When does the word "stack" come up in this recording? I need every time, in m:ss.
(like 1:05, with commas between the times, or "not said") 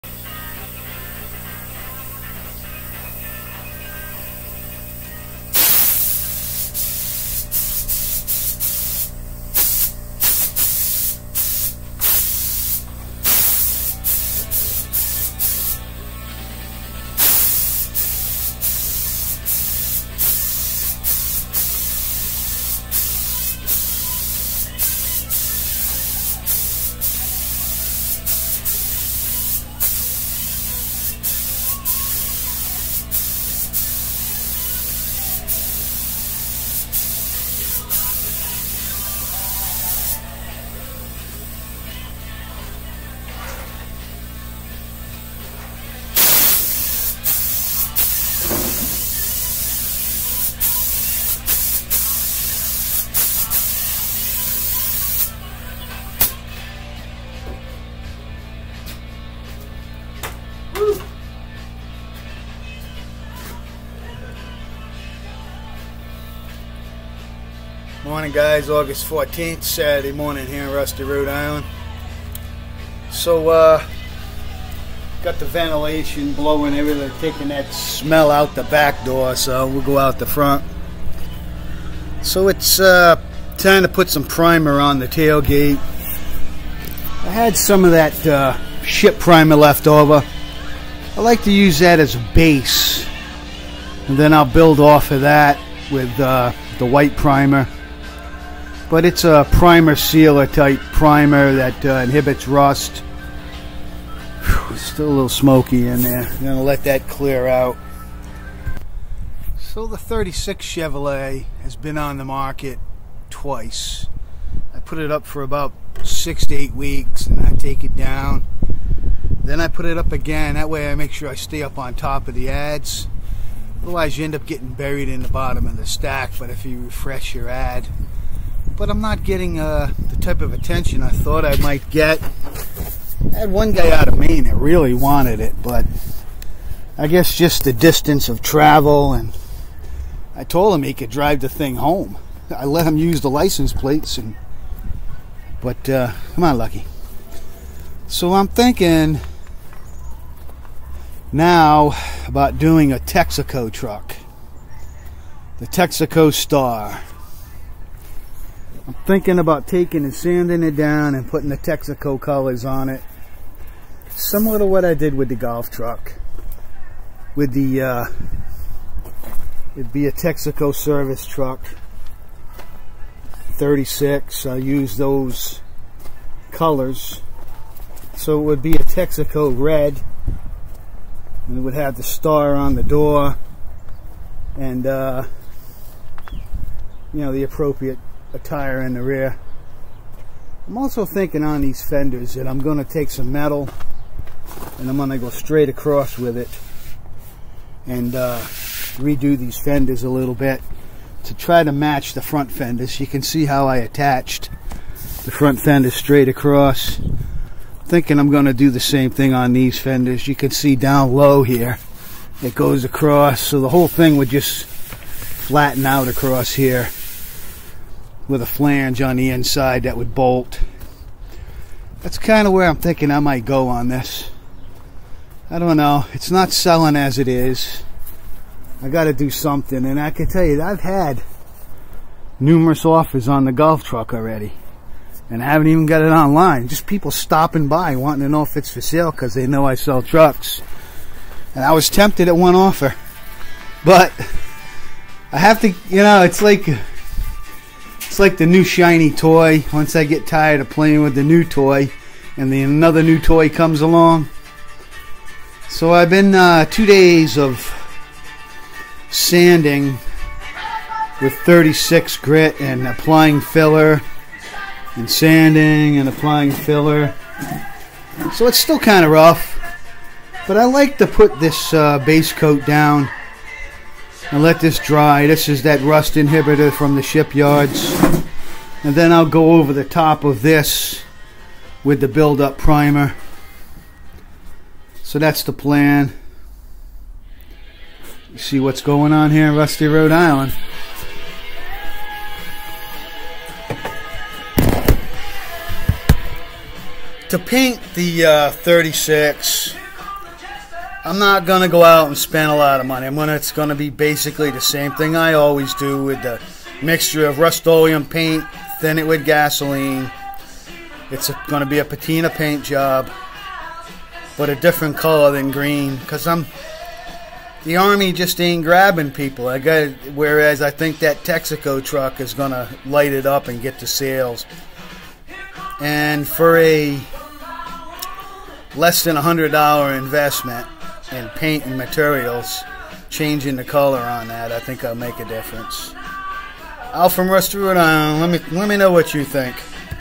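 2:05.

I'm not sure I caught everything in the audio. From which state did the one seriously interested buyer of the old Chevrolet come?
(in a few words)
Maine.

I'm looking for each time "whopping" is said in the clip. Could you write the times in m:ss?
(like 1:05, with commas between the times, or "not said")
not said.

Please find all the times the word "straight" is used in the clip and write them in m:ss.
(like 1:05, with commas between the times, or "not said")
3:15, 3:25.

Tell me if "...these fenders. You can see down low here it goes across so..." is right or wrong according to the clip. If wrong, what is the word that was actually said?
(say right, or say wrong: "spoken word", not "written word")
right.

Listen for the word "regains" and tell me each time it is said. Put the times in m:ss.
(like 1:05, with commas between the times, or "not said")
not said.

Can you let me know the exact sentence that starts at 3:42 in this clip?
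That's kind of where I'm thinking I might go on this.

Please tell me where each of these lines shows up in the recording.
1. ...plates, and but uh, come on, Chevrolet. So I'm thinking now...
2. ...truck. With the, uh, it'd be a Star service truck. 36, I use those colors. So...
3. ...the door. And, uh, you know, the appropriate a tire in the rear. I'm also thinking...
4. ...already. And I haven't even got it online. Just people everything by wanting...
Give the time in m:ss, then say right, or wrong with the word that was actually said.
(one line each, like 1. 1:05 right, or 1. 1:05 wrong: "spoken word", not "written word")
1. 2:23 wrong: "Lucky", not "Chevrolet"
2. 2:45 wrong: "Texaco", not "Star"
3. 3:02 right
4. 3:54 wrong: "stopping", not "everything".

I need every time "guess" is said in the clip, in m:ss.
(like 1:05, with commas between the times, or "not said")
2:17.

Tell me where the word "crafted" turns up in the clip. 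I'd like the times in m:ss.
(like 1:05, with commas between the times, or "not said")
not said.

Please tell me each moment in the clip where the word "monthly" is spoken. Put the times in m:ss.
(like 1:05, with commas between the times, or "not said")
not said.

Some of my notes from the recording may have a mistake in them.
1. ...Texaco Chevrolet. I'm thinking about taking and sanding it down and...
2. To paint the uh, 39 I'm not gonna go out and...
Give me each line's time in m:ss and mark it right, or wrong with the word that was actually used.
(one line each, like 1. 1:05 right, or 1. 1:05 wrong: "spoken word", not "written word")
1. 2:35 wrong: "Star", not "Chevrolet"
2. 4:57 wrong: "36", not "39".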